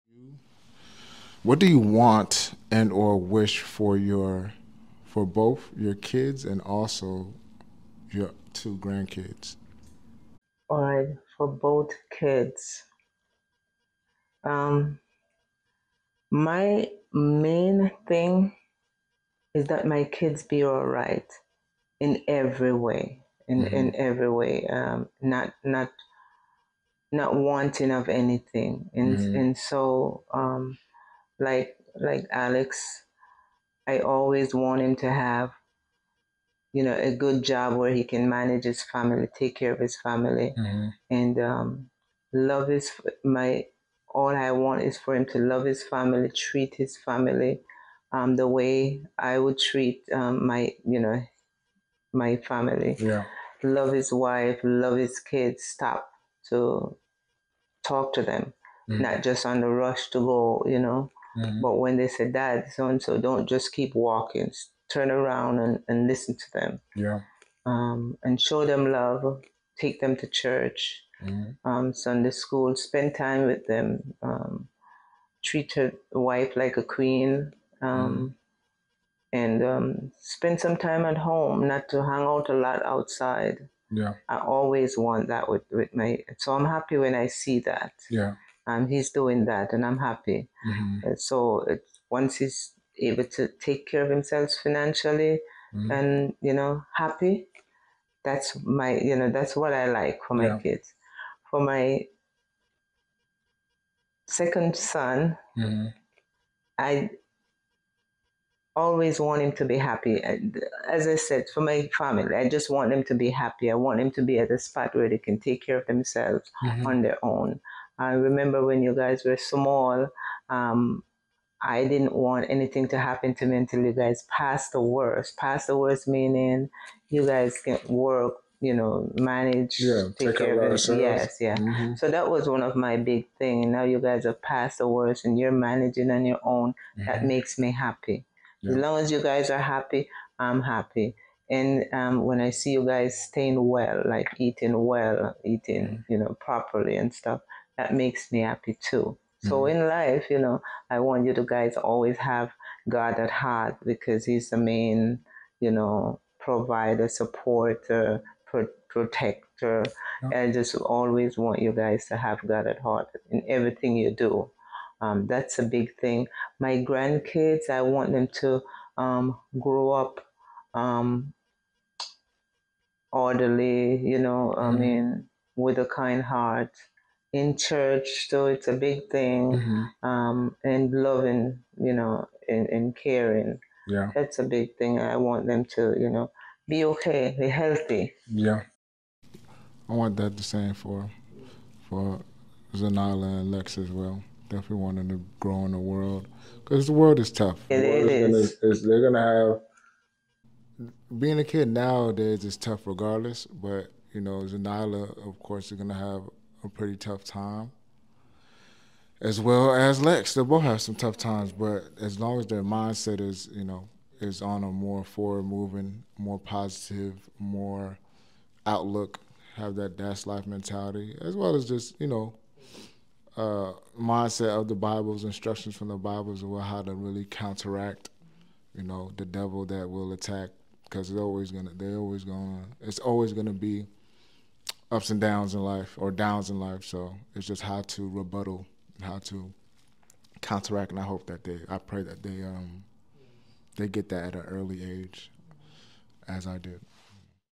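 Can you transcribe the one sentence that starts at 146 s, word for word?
you know, properly and stuff, that makes me happy too.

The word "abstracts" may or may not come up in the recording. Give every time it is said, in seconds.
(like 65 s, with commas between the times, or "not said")
not said.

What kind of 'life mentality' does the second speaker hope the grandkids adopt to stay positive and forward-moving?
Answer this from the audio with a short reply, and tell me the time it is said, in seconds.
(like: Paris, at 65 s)
dash life mentality, at 219 s.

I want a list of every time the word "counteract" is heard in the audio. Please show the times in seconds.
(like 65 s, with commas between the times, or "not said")
227 s, 240 s.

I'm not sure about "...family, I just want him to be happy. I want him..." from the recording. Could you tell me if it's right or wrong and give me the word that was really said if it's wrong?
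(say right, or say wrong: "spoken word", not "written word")
right.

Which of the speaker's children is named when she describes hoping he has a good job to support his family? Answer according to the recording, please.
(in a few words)
Alex.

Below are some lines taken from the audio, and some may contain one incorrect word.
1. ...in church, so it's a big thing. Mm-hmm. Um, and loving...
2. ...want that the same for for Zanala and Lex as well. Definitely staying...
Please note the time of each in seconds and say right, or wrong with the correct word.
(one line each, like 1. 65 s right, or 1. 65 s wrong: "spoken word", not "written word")
1. 177 s right
2. 189 s wrong: "wanting", not "staying".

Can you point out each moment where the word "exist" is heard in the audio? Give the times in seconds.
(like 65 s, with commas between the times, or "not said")
not said.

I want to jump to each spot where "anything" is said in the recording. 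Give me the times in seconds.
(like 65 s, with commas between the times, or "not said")
28 s, 122 s.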